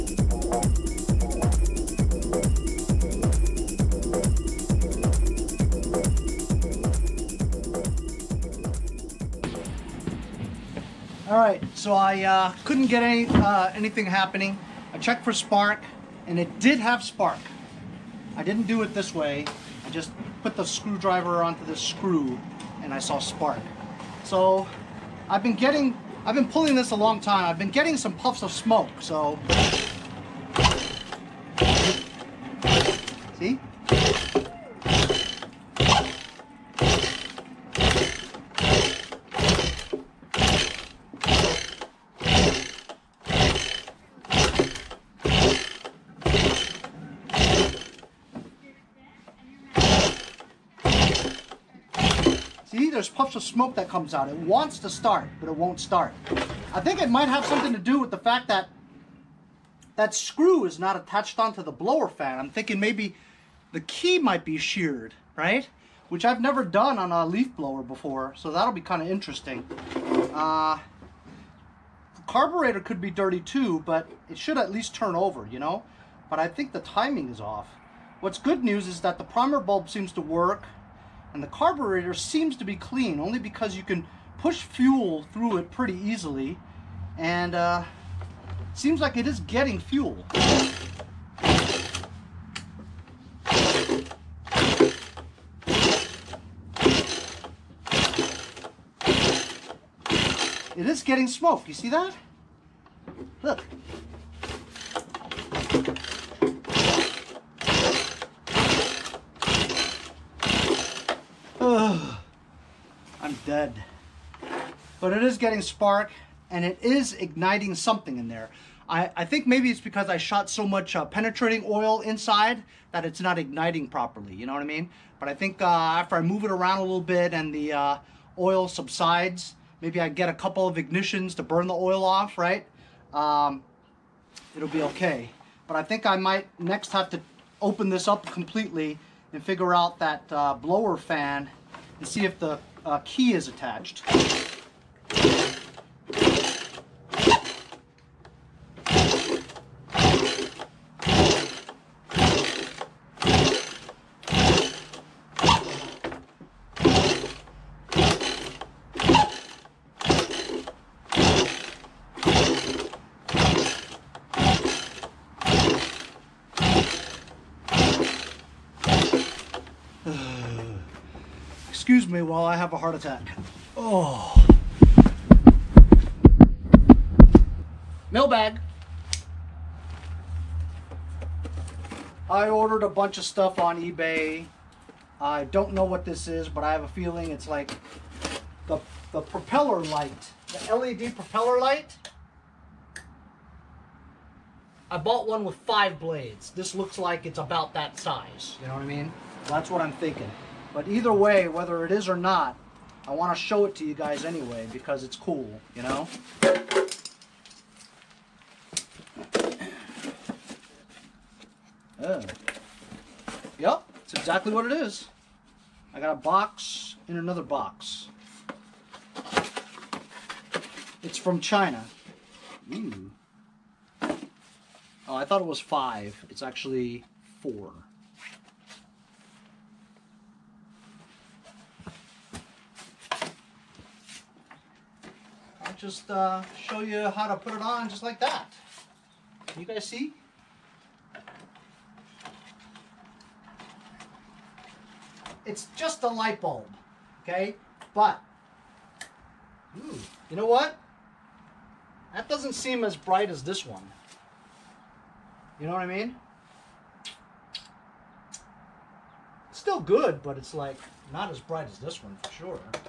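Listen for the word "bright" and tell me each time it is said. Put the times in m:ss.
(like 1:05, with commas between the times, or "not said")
4:12, 4:21.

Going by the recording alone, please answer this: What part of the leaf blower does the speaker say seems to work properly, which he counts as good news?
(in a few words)
primer bulb.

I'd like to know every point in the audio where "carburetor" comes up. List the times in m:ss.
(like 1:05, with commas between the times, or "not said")
1:12, 1:21.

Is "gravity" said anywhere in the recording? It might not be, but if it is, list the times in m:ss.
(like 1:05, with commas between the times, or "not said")
not said.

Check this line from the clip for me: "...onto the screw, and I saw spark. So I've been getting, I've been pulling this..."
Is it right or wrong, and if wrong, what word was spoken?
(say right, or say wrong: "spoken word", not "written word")
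right.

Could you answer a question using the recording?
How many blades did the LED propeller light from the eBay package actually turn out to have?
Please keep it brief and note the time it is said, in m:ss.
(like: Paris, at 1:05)
4, at 3:47.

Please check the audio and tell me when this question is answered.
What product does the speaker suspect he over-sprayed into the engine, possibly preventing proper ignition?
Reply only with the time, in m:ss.
2:01.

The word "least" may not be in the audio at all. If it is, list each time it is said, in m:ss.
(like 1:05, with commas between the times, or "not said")
1:14.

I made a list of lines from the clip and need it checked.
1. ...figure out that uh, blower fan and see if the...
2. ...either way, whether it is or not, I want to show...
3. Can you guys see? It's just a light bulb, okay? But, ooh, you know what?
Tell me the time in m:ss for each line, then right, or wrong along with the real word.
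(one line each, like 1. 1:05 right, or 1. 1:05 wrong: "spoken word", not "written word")
1. 2:19 right
2. 3:20 right
3. 3:59 right.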